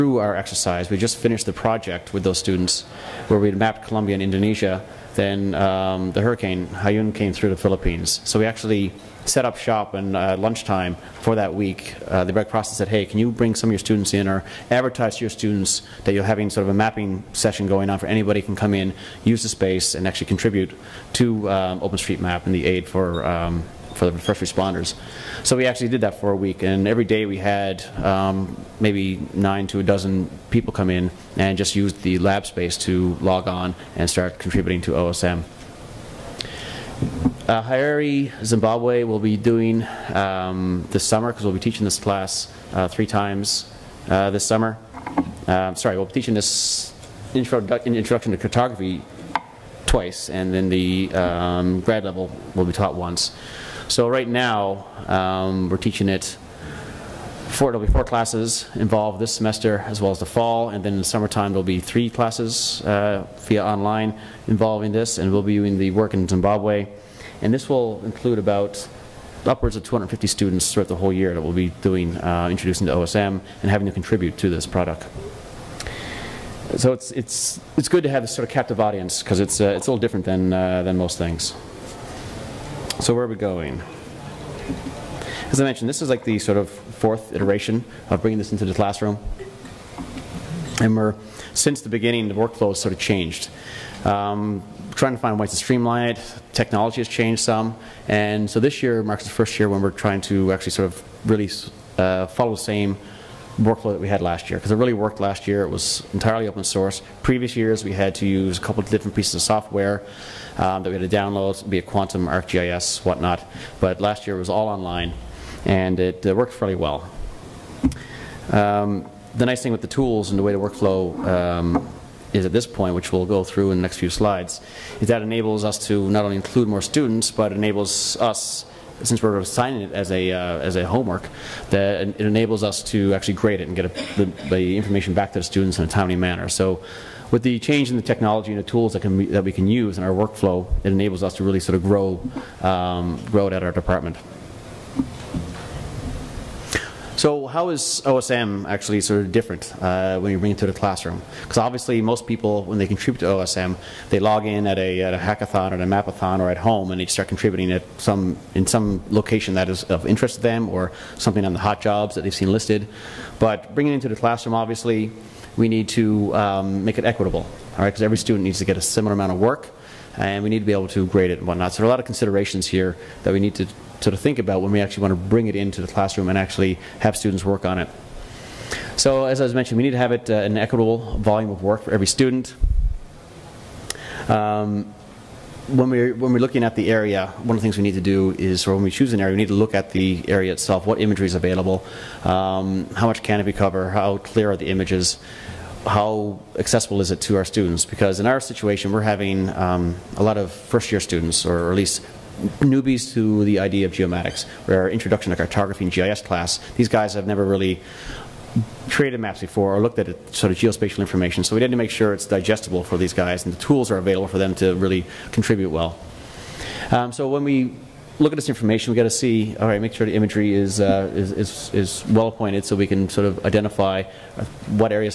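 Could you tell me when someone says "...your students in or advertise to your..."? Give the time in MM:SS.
00:13.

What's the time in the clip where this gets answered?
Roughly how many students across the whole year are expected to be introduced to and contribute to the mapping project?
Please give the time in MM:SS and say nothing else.
01:09.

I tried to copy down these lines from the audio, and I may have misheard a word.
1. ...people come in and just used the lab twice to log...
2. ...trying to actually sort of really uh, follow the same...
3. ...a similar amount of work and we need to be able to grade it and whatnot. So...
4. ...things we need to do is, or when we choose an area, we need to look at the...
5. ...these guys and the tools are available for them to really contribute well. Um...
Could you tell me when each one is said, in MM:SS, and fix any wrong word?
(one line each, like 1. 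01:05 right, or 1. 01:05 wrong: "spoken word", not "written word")
1. 00:30 wrong: "space", not "twice"
2. 01:39 right
3. 02:48 right
4. 03:07 right
5. 03:32 right.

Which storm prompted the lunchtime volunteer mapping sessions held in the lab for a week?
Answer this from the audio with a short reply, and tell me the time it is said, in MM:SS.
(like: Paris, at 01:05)
Hurricane Haiyan, at 00:06.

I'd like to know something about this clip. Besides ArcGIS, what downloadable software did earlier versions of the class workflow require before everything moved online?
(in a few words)
Quantum.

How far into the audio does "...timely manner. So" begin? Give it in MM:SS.
02:15.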